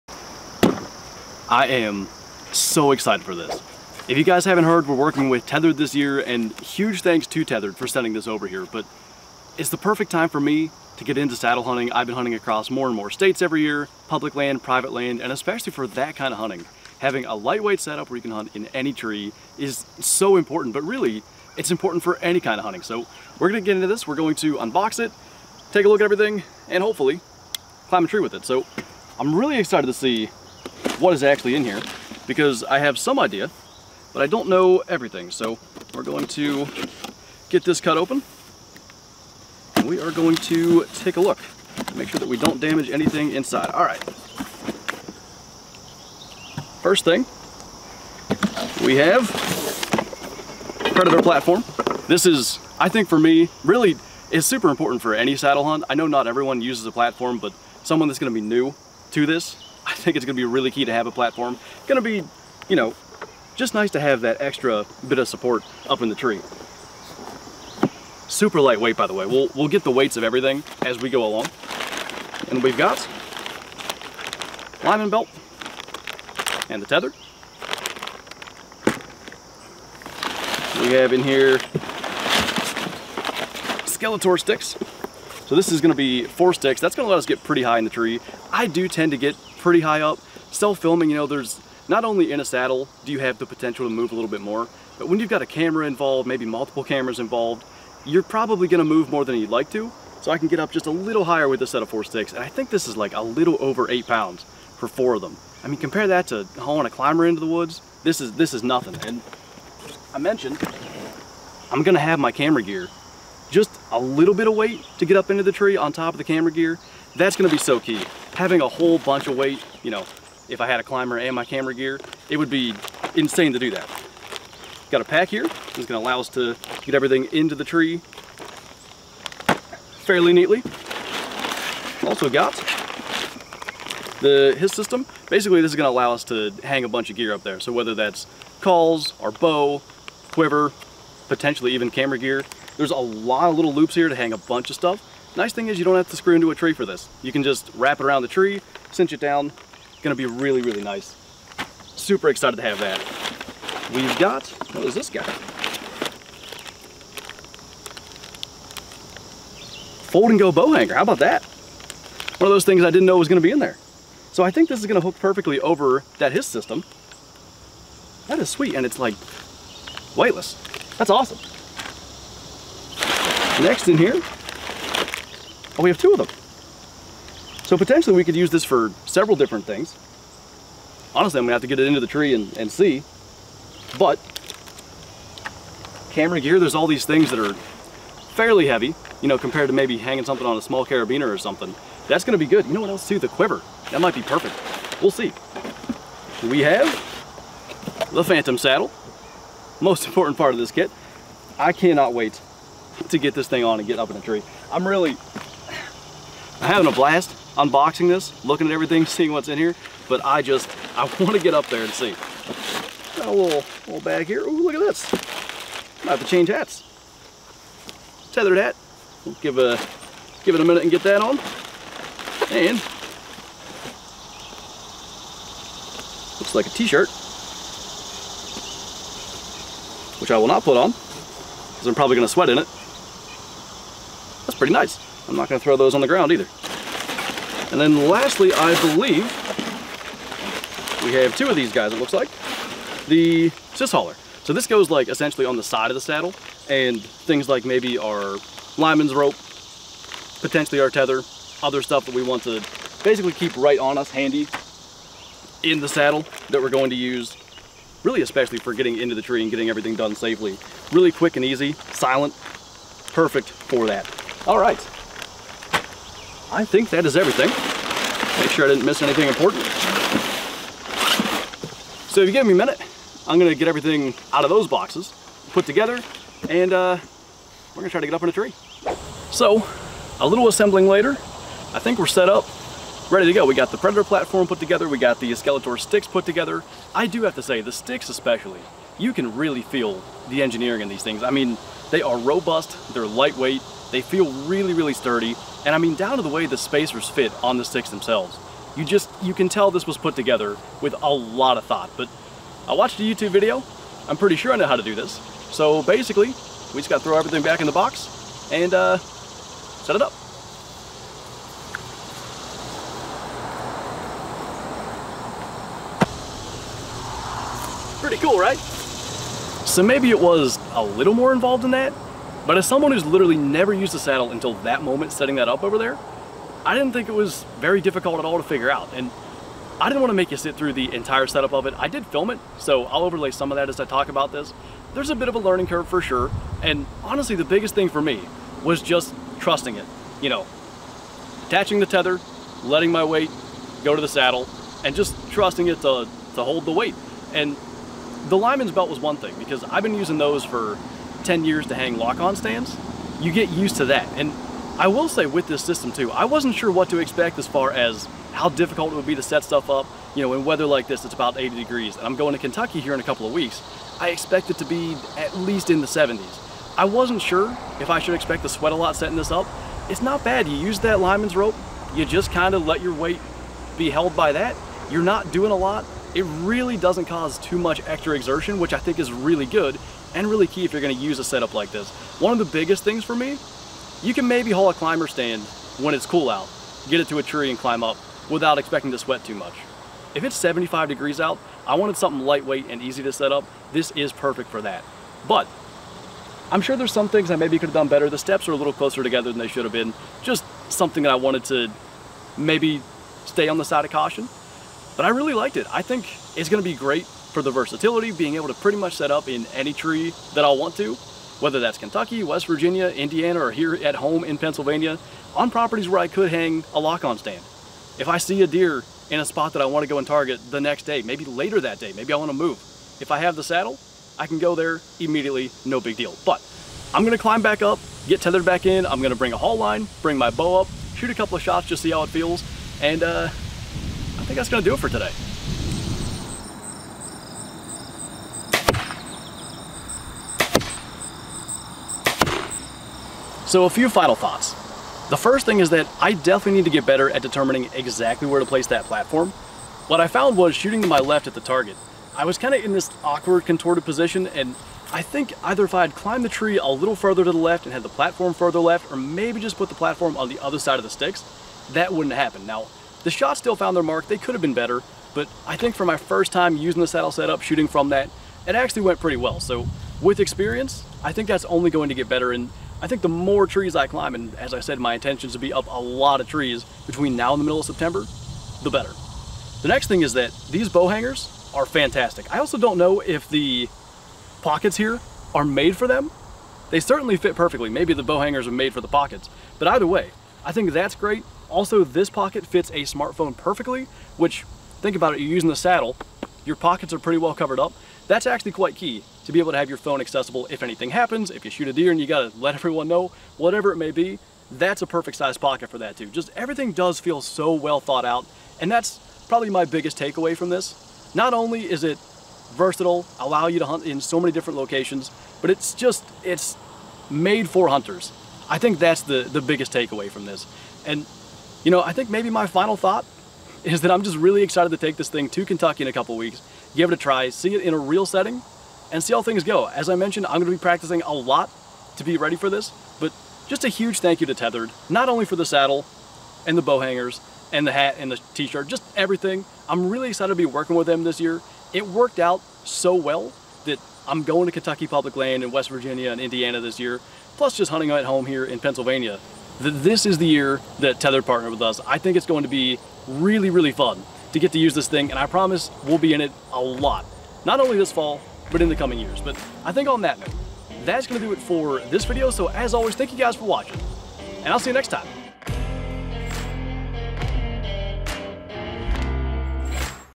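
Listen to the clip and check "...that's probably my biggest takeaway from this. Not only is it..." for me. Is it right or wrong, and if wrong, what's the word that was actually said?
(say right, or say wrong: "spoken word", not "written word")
right.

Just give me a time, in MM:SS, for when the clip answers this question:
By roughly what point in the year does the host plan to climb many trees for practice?
07:57.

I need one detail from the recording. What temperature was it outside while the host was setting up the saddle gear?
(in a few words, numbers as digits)
80 degrees.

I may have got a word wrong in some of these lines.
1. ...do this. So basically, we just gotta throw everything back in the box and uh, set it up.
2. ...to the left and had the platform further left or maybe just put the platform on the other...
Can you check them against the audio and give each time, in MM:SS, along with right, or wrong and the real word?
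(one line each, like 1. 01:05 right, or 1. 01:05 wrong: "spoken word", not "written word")
1. 05:04 right
2. 07:37 right.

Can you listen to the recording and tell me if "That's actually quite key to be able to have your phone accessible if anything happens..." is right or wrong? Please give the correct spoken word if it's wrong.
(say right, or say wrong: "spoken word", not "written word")
right.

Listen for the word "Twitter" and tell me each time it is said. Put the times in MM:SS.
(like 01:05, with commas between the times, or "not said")
not said.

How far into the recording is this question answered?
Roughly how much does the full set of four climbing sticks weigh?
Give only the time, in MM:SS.
01:43.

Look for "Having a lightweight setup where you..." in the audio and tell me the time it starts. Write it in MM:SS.
00:16.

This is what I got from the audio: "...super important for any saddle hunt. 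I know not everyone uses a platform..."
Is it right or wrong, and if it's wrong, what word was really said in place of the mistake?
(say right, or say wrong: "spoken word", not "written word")
right.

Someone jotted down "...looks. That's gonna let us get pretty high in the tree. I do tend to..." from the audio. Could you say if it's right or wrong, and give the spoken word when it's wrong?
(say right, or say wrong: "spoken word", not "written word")
wrong: "sticks", not "looks".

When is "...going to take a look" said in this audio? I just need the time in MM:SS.
00:40.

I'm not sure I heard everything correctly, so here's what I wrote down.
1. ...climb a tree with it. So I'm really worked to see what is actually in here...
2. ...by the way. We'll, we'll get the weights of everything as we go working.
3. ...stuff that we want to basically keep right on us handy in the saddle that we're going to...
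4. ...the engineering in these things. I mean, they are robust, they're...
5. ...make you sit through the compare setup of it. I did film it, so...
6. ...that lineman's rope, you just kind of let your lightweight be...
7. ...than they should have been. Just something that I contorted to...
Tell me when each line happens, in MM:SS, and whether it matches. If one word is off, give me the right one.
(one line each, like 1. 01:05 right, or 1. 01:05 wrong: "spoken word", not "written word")
1. 00:27 wrong: "excited", not "worked"
2. 01:08 wrong: "along", not "working"
3. 04:11 right
4. 04:50 right
5. 05:30 wrong: "entire", not "compare"
6. 06:10 wrong: "weight", not "lightweight"
7. 06:39 wrong: "wanted", not "contorted".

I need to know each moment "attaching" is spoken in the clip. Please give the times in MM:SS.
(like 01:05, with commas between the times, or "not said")
05:41.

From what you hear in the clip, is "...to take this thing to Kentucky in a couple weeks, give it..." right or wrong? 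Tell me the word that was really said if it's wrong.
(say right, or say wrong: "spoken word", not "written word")
right.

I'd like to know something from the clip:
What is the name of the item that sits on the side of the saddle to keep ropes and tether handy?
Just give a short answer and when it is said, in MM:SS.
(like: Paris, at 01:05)
cis hauler, at 04:03.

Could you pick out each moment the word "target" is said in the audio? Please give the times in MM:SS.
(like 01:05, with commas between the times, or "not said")
07:00, 07:31.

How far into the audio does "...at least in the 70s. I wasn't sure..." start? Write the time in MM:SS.
06:05.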